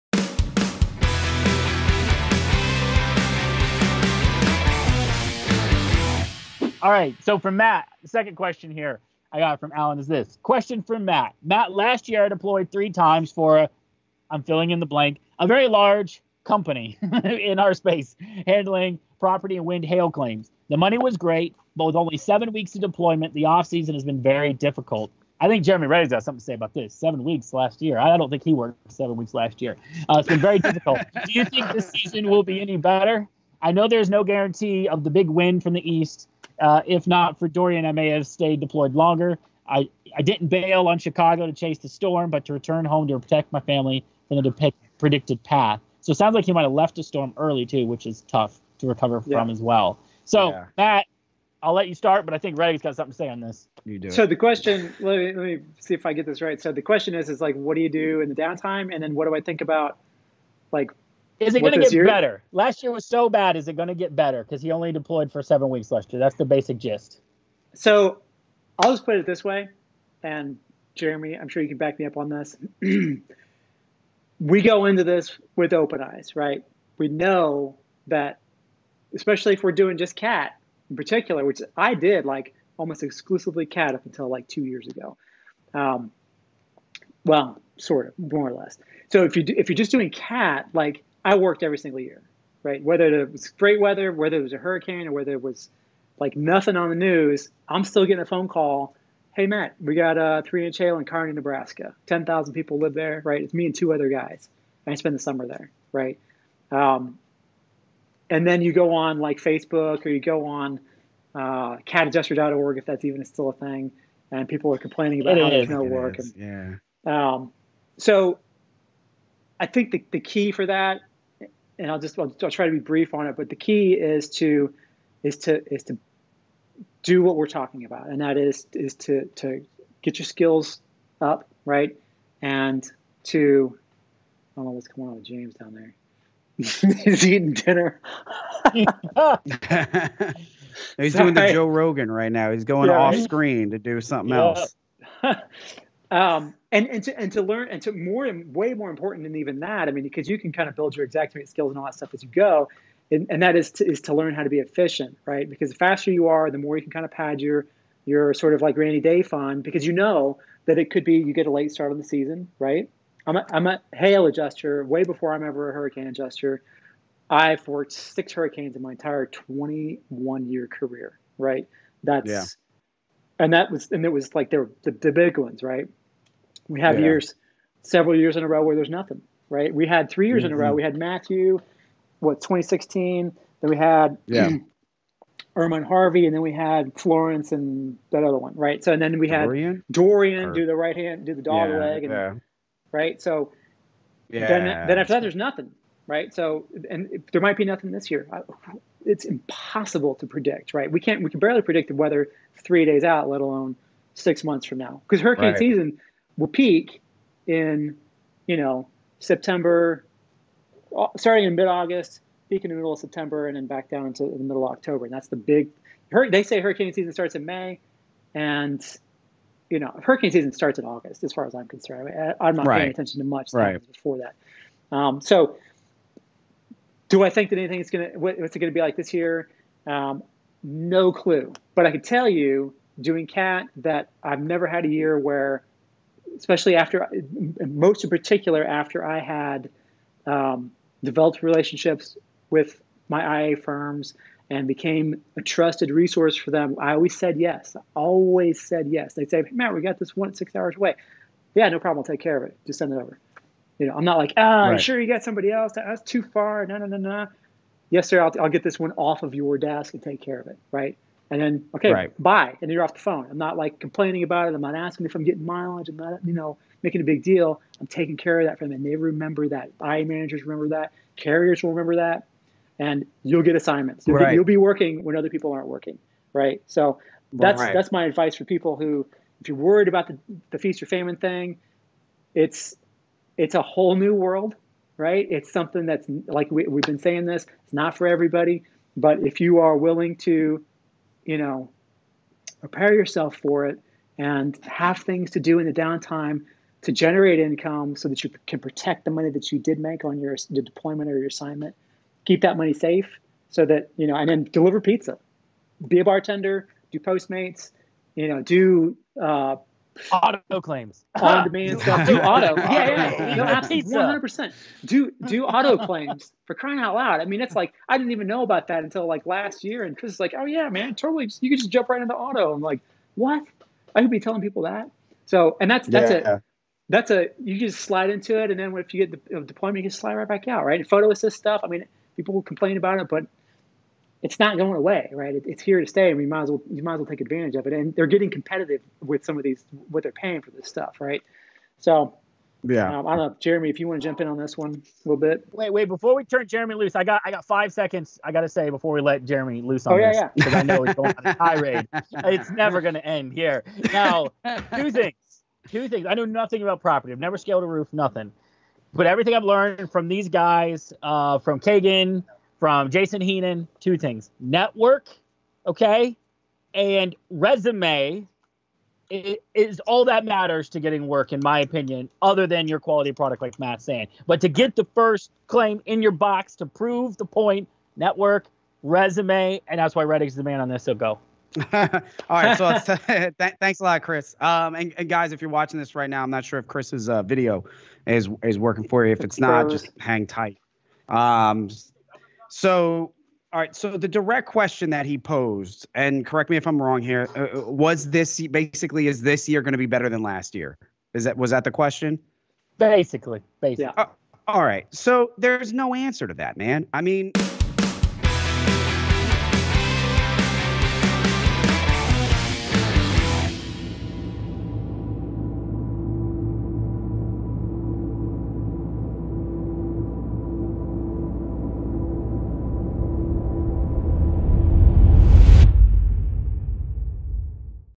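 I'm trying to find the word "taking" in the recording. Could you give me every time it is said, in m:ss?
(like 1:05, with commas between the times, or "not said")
4:27.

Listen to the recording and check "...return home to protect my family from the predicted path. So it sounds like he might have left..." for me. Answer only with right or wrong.
right.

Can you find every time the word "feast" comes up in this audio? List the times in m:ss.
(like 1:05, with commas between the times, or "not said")
4:40.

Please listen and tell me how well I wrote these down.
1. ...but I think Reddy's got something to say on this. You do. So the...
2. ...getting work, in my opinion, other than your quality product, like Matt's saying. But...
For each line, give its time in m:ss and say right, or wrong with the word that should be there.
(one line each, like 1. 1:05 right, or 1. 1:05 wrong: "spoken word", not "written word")
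1. 0:52 right
2. 6:10 right.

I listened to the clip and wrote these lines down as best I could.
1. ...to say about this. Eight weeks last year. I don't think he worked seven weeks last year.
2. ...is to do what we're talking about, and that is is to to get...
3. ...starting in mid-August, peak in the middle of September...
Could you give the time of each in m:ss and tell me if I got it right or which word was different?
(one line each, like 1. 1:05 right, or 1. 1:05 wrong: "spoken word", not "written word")
1. 0:26 wrong: "Seven", not "Eight"
2. 2:05 right
3. 3:31 right.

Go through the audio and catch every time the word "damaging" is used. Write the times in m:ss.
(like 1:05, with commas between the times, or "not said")
not said.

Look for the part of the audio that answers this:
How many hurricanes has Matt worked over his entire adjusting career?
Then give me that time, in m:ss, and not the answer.
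2:47.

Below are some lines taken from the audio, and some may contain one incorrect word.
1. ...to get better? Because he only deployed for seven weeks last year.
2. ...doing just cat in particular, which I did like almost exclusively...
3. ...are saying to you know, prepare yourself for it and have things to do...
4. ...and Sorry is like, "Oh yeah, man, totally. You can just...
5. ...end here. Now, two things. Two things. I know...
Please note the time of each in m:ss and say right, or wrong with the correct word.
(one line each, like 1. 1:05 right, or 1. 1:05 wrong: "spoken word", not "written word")
1. 1:03 right
2. 1:19 right
3. 4:49 wrong: "willing", not "saying"
4. 5:19 wrong: "Chris", not "Sorry"
5. 5:53 right.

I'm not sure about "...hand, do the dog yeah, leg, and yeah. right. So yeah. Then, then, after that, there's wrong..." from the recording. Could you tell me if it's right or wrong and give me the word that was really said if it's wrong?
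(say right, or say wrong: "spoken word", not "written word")
wrong: "nothing", not "wrong".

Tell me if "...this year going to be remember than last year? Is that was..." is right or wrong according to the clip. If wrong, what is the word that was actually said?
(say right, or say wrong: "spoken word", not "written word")
wrong: "better", not "remember".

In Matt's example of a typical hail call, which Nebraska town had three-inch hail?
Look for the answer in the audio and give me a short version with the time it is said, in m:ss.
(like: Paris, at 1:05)
Kearney, at 1:41.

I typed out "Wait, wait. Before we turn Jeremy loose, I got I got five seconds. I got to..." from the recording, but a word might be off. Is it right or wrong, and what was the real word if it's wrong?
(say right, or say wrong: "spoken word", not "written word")
right.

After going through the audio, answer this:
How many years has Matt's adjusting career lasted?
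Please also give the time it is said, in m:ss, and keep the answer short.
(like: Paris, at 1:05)
21 years, at 2:49.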